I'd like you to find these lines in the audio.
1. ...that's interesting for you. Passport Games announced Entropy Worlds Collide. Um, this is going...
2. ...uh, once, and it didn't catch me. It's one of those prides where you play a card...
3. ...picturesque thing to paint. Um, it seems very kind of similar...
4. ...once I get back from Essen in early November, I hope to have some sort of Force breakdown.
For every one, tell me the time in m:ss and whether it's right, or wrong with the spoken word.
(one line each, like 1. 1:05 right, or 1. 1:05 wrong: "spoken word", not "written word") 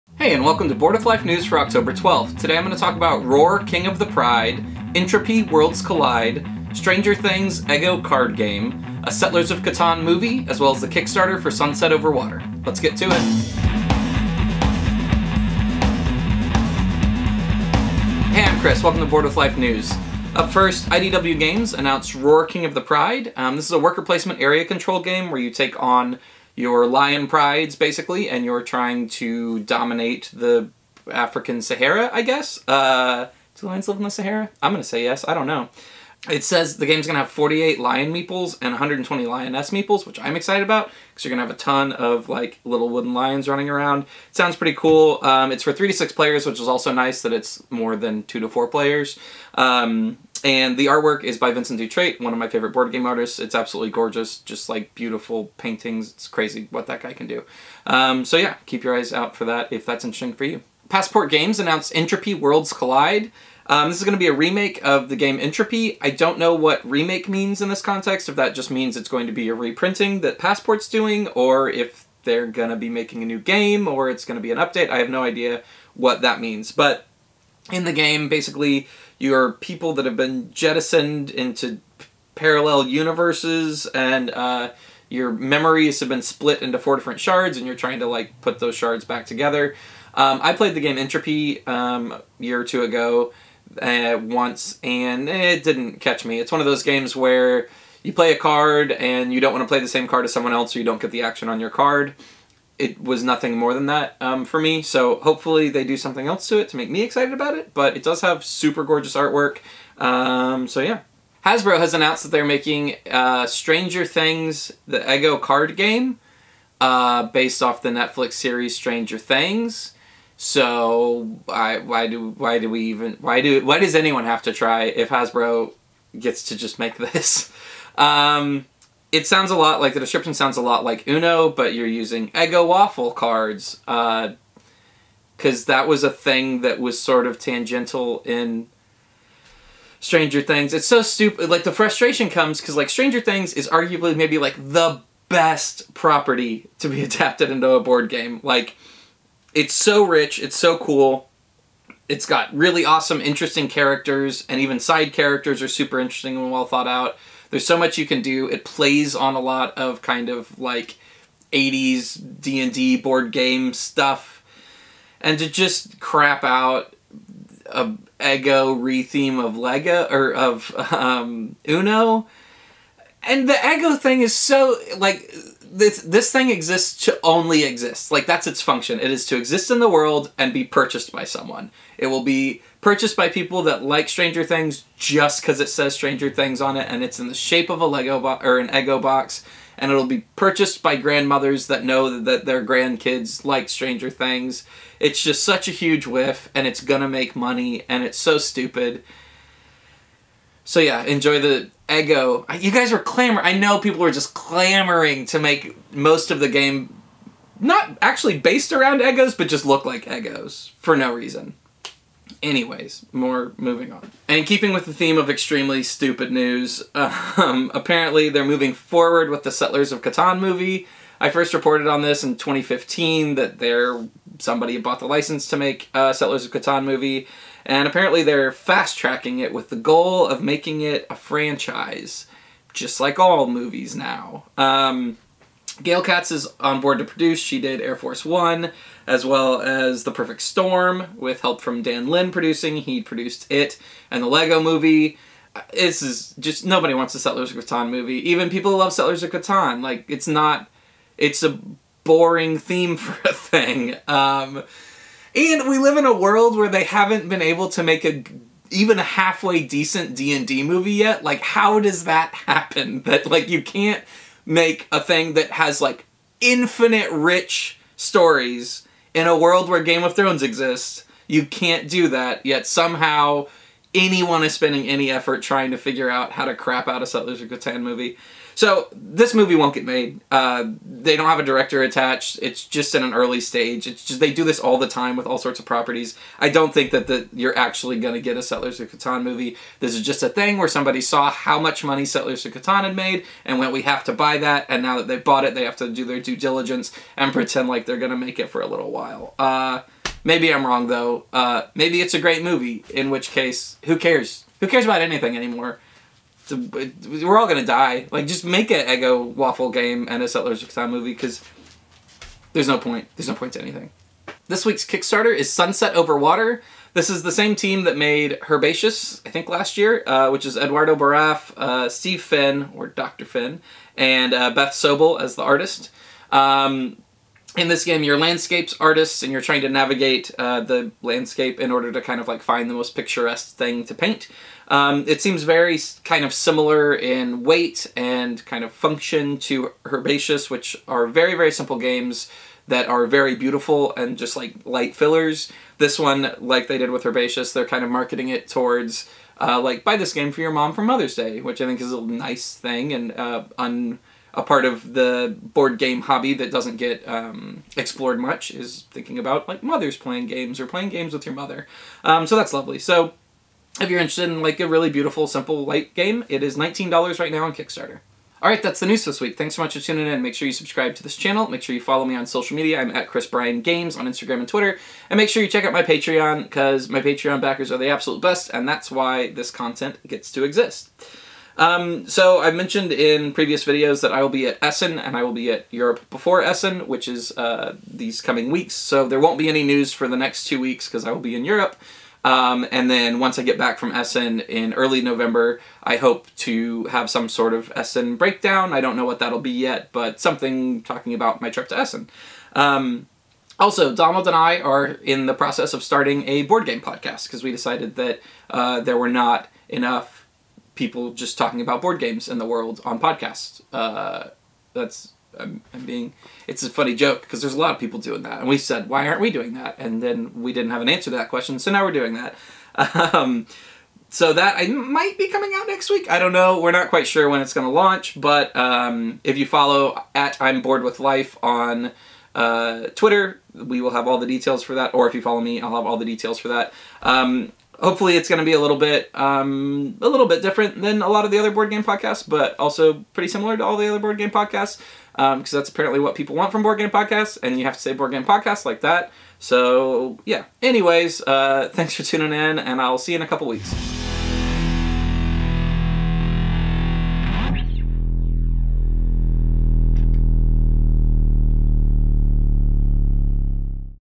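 1. 0:59 right
2. 1:33 wrong: "games", not "prides"
3. 5:32 right
4. 6:33 wrong: "Essen", not "Force".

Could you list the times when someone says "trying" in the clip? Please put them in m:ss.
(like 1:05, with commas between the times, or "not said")
0:28, 1:27, 4:35, 5:29.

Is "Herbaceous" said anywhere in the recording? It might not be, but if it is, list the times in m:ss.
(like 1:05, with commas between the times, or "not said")
5:18, 5:39, 5:47.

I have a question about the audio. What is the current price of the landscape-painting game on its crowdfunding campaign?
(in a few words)
$19.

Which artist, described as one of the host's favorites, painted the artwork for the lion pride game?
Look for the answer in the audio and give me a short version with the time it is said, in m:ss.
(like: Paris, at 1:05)
Vincent Dutrait, at 0:51.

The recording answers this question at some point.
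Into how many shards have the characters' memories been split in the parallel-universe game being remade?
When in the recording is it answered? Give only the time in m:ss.
1:26.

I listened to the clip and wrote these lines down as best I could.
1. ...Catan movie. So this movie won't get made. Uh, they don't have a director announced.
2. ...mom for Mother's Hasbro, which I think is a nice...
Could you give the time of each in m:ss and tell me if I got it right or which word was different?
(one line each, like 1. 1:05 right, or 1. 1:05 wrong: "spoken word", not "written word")
1. 4:37 wrong: "attached", not "announced"
2. 5:50 wrong: "Day", not "Hasbro".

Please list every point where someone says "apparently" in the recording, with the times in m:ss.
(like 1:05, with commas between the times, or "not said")
3:37, 3:47, 7:25.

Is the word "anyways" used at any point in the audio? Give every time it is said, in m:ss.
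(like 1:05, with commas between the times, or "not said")
3:32, 7:30.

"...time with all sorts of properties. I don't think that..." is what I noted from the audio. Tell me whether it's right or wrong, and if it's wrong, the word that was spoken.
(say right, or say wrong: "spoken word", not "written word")
right.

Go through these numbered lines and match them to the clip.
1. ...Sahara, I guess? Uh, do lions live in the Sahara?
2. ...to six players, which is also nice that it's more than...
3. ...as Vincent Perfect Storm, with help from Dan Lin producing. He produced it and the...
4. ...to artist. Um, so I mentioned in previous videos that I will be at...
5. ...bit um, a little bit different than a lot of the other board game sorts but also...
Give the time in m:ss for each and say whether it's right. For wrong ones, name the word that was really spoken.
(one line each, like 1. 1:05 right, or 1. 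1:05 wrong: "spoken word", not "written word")
1. 0:31 right
2. 0:45 right
3. 3:59 wrong: "The", not "Vincent"
4. 6:20 wrong: "exist", not "artist"
5. 7:18 wrong: "podcasts", not "sorts".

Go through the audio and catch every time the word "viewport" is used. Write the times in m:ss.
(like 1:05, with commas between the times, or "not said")
not said.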